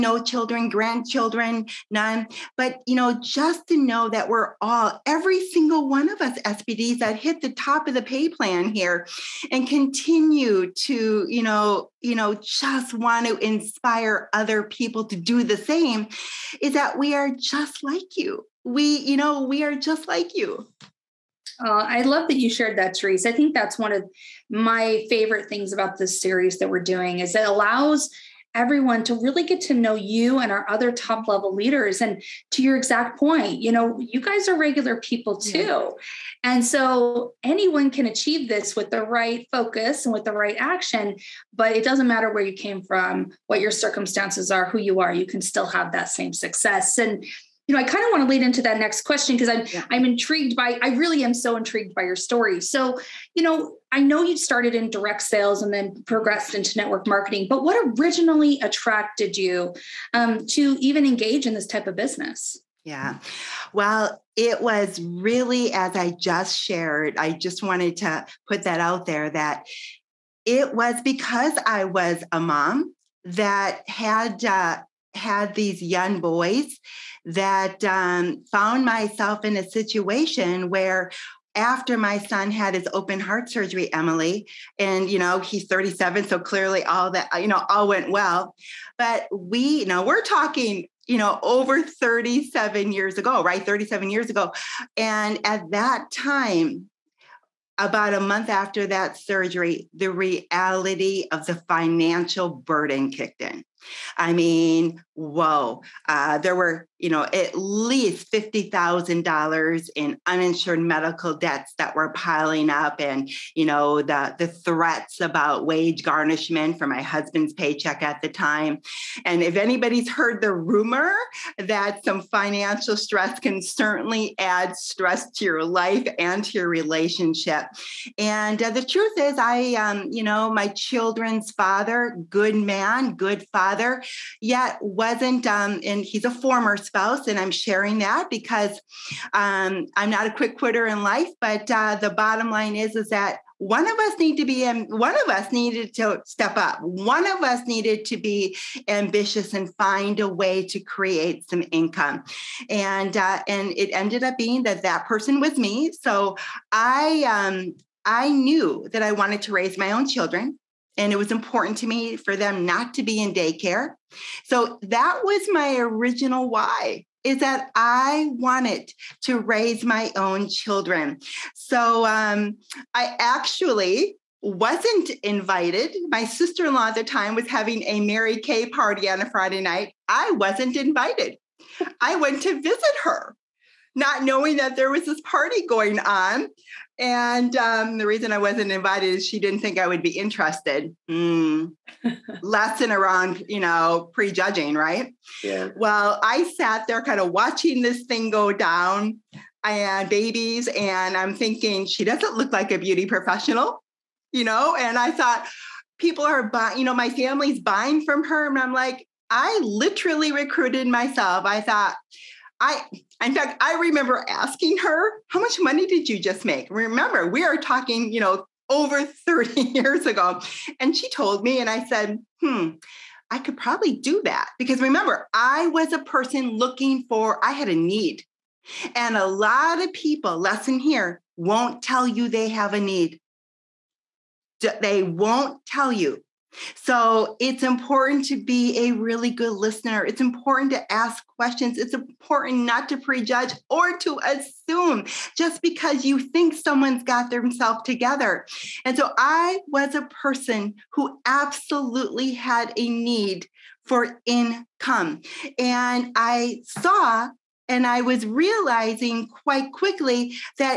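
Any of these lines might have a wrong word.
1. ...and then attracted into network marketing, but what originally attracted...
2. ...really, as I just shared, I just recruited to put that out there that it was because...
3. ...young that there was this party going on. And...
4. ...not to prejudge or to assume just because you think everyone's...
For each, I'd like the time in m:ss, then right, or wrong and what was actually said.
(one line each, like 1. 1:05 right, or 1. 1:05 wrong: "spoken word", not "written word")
1. 0:55 wrong: "progressed", not "attracted"
2. 1:05 wrong: "wanted", not "recruited"
3. 3:04 wrong: "knowing", not "young"
4. 4:02 wrong: "someone", not "everyone".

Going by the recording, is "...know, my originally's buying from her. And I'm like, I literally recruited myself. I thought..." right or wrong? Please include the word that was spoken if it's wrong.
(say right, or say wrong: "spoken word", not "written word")
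wrong: "family", not "originally".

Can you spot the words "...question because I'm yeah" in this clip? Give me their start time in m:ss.
0:49.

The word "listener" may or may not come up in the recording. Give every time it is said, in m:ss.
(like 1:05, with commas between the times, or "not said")
3:59.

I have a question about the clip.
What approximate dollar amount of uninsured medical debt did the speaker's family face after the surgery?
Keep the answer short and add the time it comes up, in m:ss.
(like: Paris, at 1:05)
$50,000, at 1:48.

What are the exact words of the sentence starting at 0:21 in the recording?
Uh, I love that you shared that, Terese.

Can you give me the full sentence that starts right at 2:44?
So that was my original why is that I wanted to raise my own children.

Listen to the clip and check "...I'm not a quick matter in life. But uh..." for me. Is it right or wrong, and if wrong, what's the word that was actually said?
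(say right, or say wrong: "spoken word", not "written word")
wrong: "quitter", not "matter".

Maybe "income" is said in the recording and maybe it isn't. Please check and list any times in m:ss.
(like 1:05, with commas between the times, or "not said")
2:31, 4:14.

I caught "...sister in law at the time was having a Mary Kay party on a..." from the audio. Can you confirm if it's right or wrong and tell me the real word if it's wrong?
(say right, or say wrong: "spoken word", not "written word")
right.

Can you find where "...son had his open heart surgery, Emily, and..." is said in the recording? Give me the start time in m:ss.
1:22.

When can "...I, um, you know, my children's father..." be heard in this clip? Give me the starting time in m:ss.
2:09.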